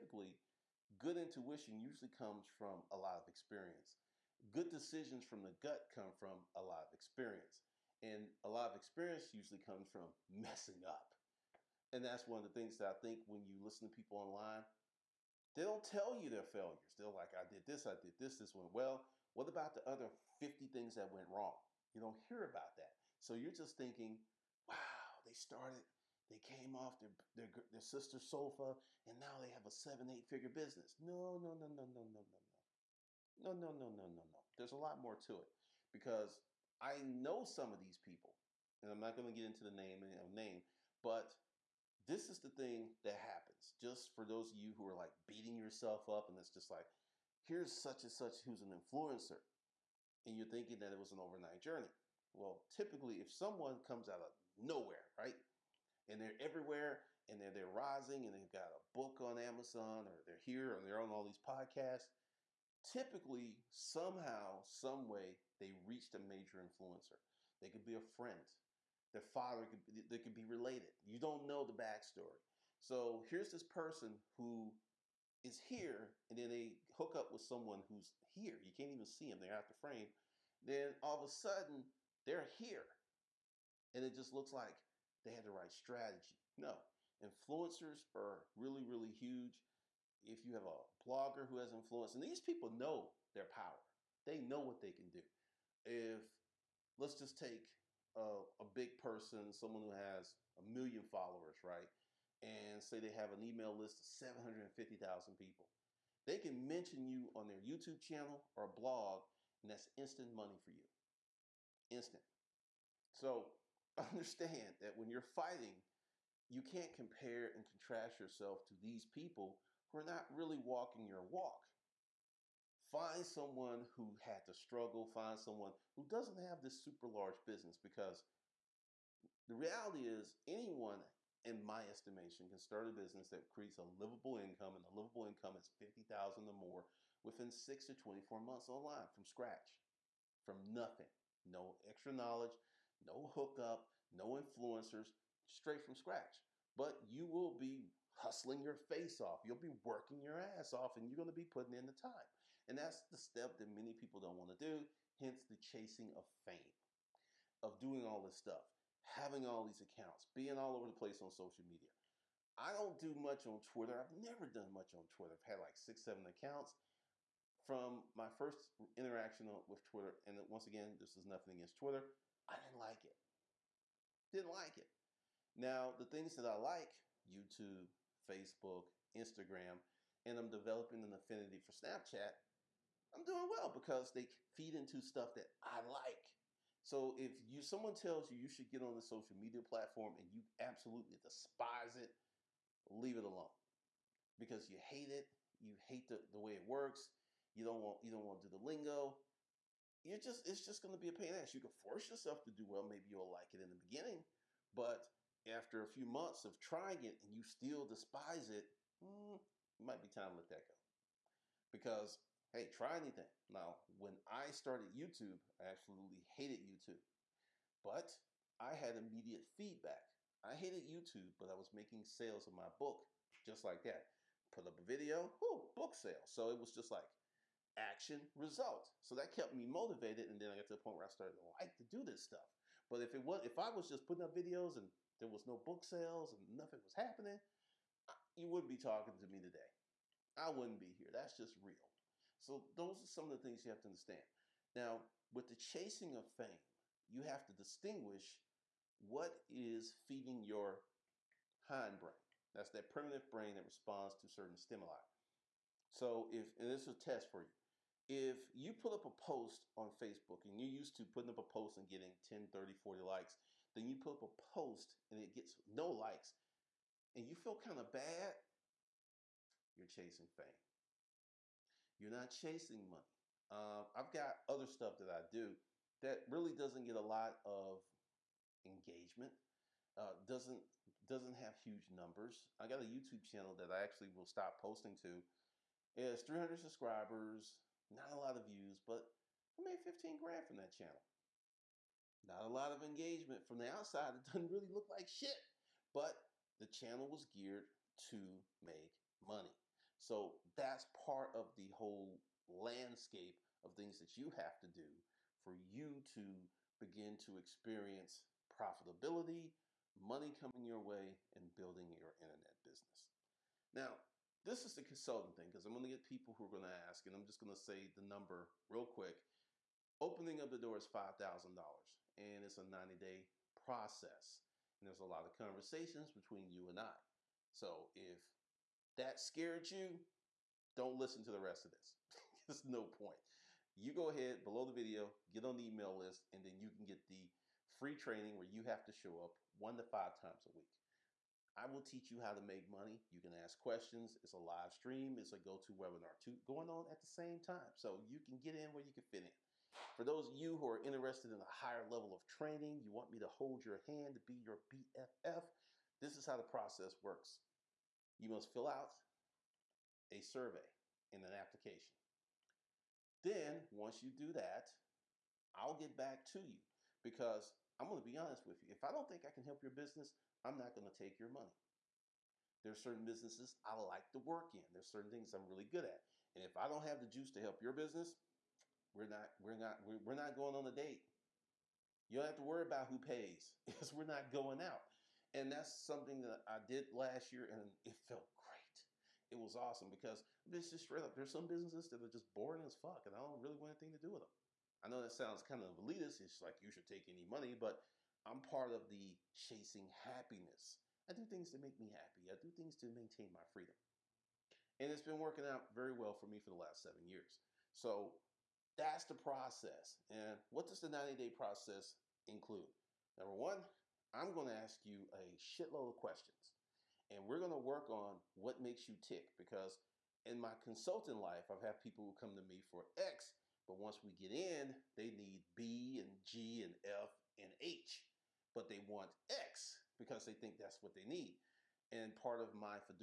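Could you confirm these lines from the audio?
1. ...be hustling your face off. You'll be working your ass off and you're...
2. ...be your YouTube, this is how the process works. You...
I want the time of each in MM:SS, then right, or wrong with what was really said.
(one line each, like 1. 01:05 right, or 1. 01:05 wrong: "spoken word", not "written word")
1. 02:27 right
2. 05:54 wrong: "BFF", not "YouTube".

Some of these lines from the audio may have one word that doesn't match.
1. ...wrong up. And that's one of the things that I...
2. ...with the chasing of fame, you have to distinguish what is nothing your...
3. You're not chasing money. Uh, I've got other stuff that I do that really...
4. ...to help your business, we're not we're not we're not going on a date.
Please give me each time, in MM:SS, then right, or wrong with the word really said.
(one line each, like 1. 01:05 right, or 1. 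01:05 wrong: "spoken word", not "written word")
1. 00:10 wrong: "messing", not "wrong"
2. 04:05 wrong: "feeding", not "nothing"
3. 04:31 right
4. 06:17 right.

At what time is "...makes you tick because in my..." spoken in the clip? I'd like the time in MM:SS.
06:58.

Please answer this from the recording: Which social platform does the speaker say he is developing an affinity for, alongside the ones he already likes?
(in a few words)
Snapchat.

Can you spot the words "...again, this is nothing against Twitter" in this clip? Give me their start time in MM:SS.
02:50.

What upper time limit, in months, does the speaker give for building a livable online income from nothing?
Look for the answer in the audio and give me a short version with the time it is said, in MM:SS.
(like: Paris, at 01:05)
24 months, at 02:17.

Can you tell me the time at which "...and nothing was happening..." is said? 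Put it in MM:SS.
03:56.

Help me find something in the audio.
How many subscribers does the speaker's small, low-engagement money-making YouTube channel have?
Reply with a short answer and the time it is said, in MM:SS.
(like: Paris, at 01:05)
300, at 04:46.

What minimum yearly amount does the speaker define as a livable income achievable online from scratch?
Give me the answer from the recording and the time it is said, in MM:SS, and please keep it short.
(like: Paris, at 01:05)
50,000, at 02:15.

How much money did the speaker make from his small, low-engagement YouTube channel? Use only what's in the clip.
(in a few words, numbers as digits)
15 grand.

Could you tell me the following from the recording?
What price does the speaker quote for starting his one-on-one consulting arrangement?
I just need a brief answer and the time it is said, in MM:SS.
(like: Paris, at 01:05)
$5,000, at 05:20.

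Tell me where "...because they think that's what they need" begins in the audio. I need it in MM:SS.
07:09.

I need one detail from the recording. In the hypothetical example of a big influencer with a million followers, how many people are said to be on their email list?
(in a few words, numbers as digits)
750,000.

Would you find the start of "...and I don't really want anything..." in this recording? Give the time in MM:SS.
06:33.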